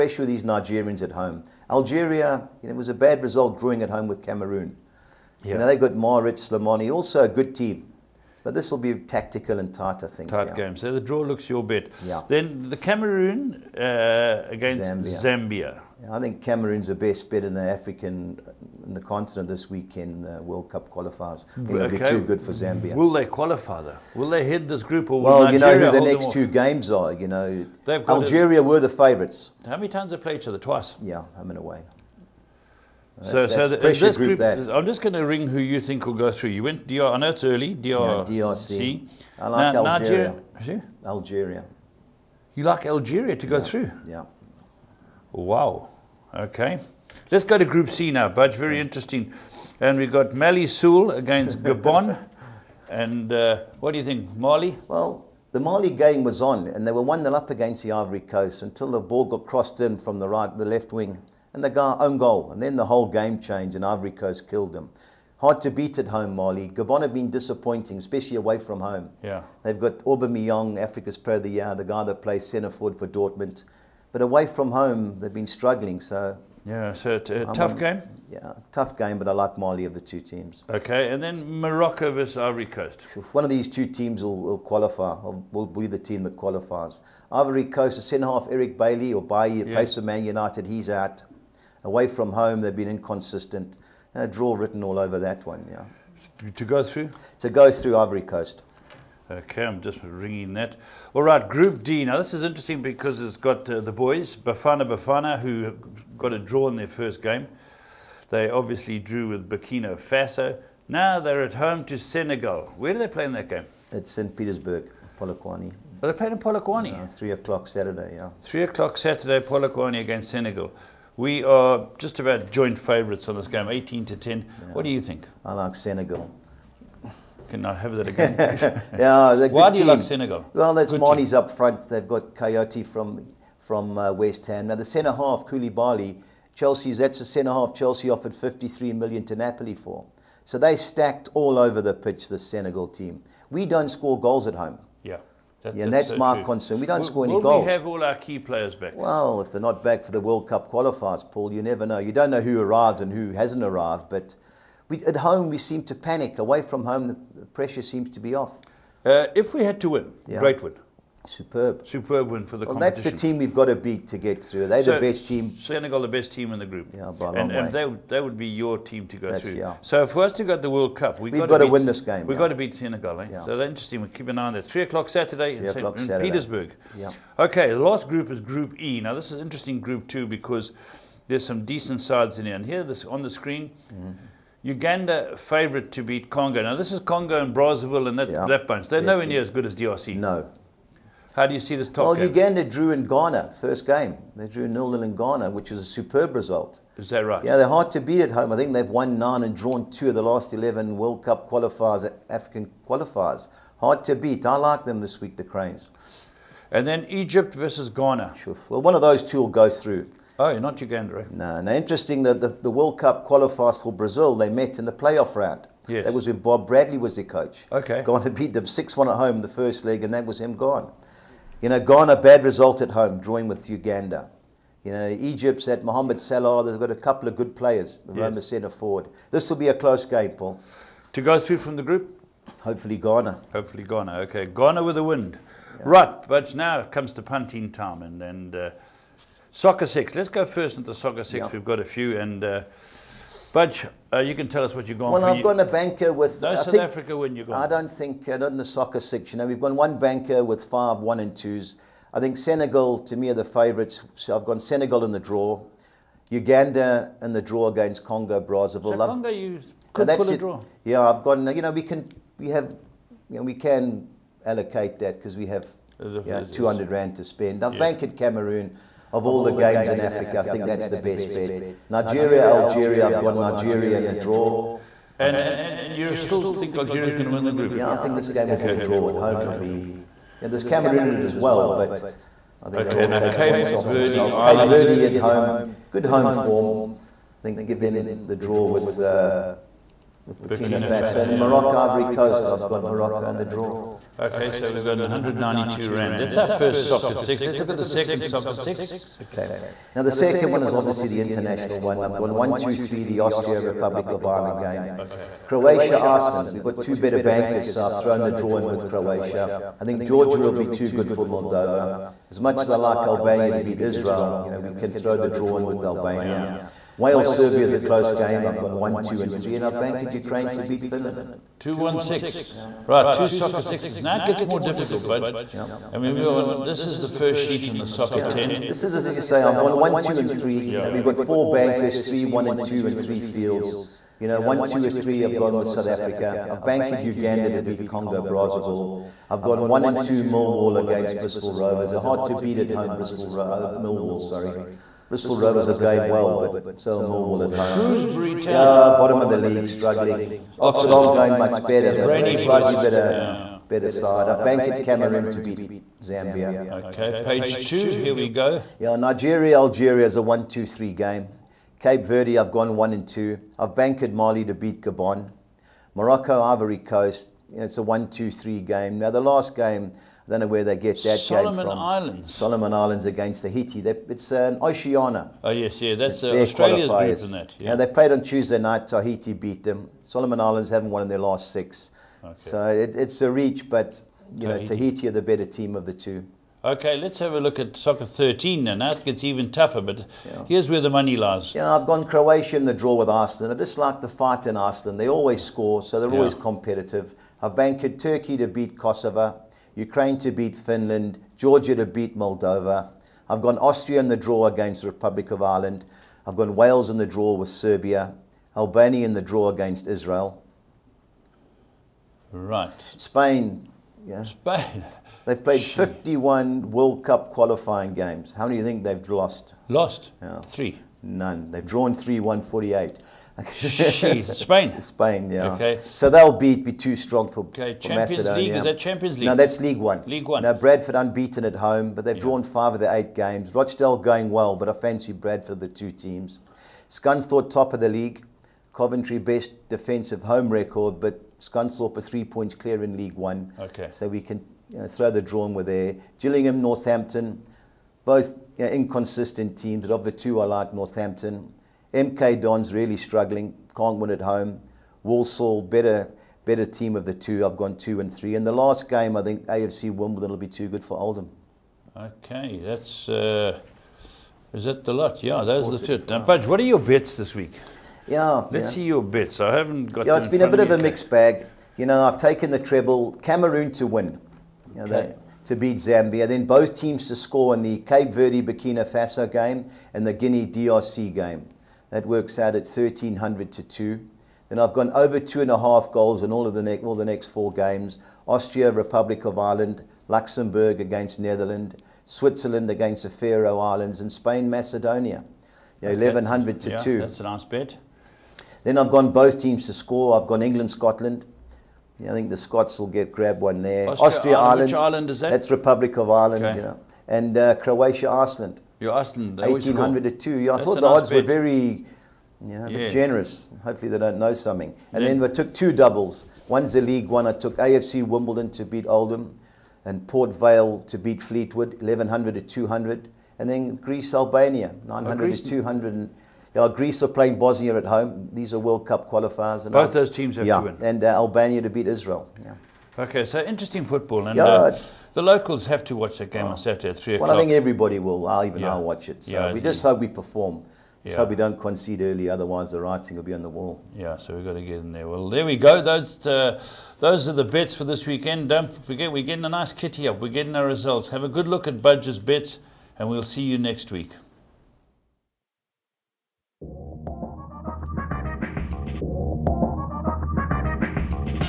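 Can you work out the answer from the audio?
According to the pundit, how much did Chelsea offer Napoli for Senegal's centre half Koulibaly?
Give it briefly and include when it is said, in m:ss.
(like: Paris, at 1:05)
53 million, at 2:18.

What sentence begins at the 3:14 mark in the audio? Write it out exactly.
They drew nil-nil in Ghana, which is a superb result.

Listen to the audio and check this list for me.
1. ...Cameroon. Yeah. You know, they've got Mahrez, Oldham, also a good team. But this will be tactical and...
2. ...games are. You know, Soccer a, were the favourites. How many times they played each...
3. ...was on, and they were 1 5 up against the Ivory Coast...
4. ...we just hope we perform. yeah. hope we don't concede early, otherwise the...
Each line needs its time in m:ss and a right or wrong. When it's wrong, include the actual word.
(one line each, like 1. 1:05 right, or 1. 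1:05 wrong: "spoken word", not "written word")
1. 0:04 wrong: "Slimani", not "Oldham"
2. 0:26 wrong: "Algeria", not "Soccer"
3. 0:56 wrong: "0", not "5"
4. 8:59 right.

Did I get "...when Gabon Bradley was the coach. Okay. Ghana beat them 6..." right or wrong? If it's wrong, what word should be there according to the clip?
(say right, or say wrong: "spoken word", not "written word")
wrong: "Bob", not "Gabon".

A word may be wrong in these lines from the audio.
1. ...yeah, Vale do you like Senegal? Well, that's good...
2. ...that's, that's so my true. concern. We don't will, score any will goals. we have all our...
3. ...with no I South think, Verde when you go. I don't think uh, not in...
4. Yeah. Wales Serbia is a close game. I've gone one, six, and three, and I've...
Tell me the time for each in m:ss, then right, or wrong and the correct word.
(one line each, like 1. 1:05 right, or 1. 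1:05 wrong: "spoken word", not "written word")
1. 2:08 wrong: "Why", not "Vale"
2. 2:25 right
3. 4:06 wrong: "Africa", not "Verde"
4. 5:16 wrong: "two", not "six".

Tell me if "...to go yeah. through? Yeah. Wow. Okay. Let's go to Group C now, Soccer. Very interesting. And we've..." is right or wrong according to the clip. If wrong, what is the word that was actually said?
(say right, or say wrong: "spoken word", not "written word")
wrong: "Budge", not "Soccer".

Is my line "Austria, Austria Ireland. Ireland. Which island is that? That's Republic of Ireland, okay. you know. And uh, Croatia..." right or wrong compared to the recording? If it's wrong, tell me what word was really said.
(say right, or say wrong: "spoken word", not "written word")
right.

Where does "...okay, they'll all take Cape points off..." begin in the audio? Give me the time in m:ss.
4:42.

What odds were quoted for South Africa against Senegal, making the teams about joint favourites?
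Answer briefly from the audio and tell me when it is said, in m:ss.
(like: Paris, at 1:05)
18 to 10, at 2:03.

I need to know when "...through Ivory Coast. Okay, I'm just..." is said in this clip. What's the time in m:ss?
1:37.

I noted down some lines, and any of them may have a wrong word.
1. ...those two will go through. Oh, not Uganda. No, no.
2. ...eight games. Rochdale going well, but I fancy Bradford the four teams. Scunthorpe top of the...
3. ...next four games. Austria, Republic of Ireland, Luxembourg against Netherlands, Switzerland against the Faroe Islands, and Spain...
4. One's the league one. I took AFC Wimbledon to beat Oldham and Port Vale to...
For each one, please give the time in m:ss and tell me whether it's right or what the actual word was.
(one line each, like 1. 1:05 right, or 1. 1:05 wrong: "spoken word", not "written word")
1. 3:29 right
2. 7:12 wrong: "two", not "four"
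3. 8:07 right
4. 8:36 right.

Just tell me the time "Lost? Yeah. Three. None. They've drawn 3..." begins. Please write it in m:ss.
6:59.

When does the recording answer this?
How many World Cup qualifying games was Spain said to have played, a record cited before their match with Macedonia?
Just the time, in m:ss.
6:55.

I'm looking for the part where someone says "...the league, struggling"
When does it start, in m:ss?
5:49.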